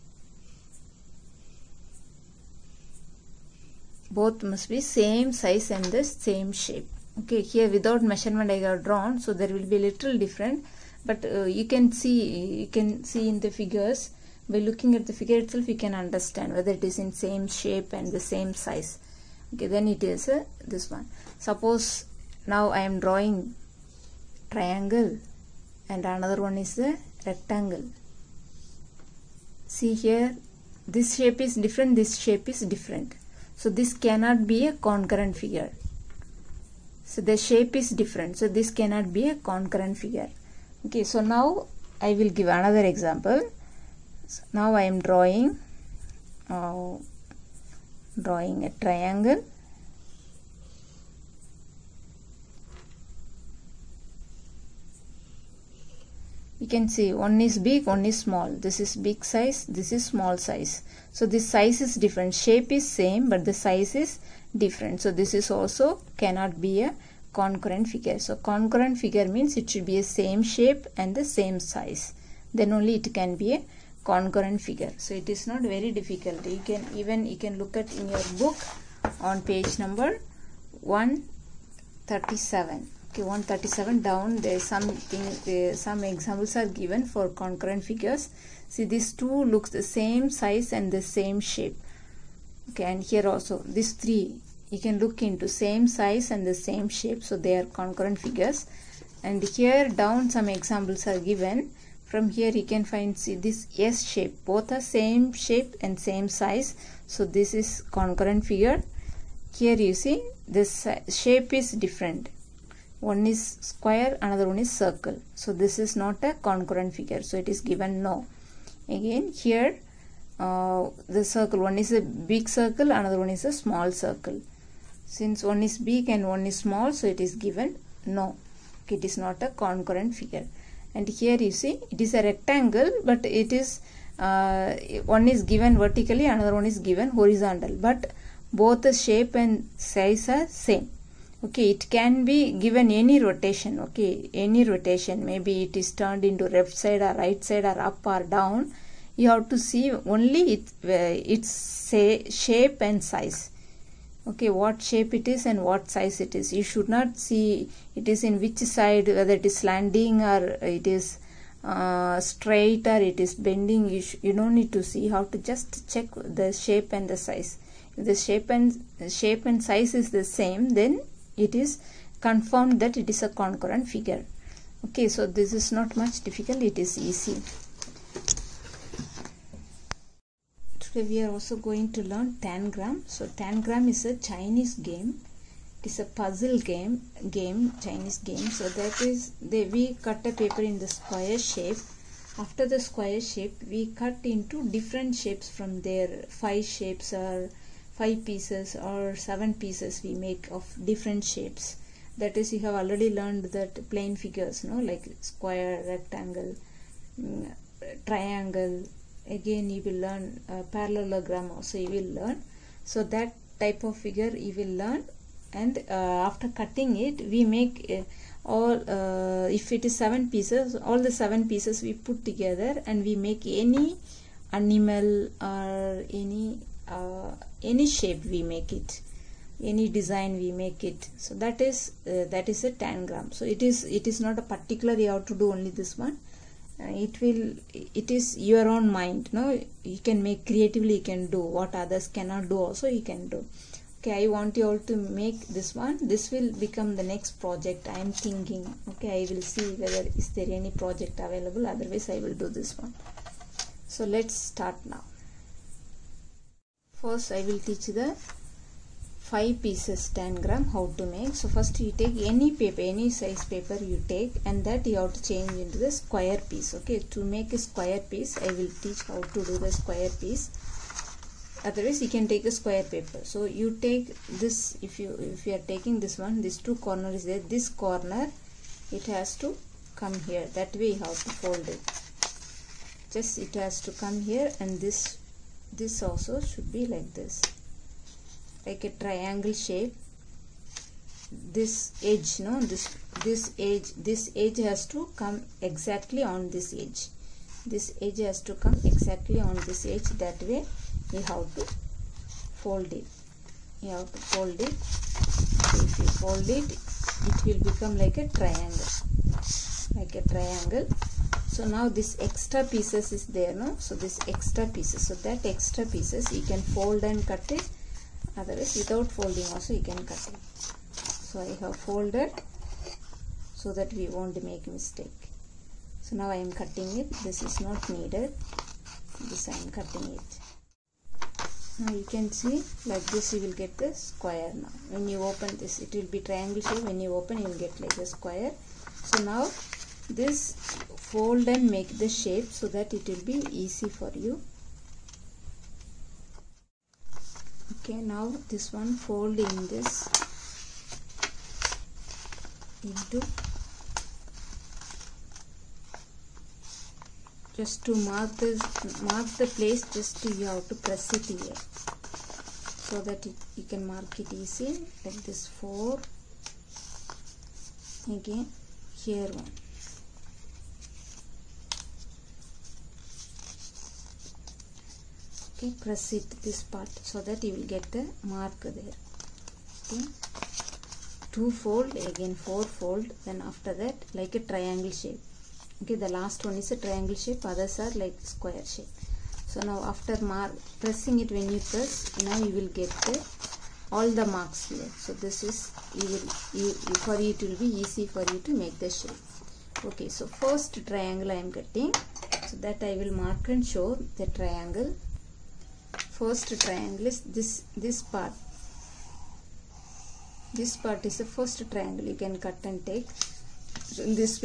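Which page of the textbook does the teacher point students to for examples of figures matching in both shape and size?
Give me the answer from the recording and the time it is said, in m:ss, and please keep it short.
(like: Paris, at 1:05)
137, at 1:19.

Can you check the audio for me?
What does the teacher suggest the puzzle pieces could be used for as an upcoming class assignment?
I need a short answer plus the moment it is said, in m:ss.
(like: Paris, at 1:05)
next project, at 4:07.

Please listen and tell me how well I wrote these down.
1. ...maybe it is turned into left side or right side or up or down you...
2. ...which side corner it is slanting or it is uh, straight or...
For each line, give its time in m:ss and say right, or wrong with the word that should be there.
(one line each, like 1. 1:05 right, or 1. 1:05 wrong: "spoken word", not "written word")
1. 2:25 right
2. 2:38 wrong: "whether", not "corner".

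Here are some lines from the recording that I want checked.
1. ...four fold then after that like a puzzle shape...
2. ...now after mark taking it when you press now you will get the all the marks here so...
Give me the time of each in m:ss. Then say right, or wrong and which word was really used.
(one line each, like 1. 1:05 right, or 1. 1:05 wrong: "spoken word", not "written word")
1. 6:22 wrong: "triangle", not "puzzle"
2. 6:29 wrong: "pressing", not "taking".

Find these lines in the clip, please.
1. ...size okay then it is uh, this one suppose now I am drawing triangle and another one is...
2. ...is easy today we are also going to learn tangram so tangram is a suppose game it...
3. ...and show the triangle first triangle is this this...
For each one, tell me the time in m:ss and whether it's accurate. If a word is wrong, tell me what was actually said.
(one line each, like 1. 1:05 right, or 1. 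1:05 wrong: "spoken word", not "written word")
1. 0:18 right
2. 2:56 wrong: "chinese", not "suppose"
3. 6:43 right.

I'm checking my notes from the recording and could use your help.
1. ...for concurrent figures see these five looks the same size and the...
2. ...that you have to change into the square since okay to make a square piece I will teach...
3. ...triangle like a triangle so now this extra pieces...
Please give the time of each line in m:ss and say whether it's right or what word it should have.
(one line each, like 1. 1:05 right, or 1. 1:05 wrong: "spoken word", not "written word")
1. 1:27 wrong: "two", not "five"
2. 4:24 wrong: "piece", not "since"
3. 5:08 right.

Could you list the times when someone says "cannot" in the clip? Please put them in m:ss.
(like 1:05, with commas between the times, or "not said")
0:33, 0:38, 1:06, 4:02.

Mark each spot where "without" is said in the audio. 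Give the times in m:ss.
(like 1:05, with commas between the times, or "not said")
0:07, 5:18.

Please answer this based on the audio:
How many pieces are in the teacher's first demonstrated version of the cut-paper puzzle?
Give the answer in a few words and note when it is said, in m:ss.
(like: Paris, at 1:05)
5, at 4:19.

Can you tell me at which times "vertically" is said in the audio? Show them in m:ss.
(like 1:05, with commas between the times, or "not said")
2:15.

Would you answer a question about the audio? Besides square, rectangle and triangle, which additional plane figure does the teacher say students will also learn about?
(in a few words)
parallelogram.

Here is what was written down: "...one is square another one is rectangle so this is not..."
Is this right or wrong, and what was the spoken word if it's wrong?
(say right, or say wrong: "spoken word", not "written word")
wrong: "circle", not "rectangle".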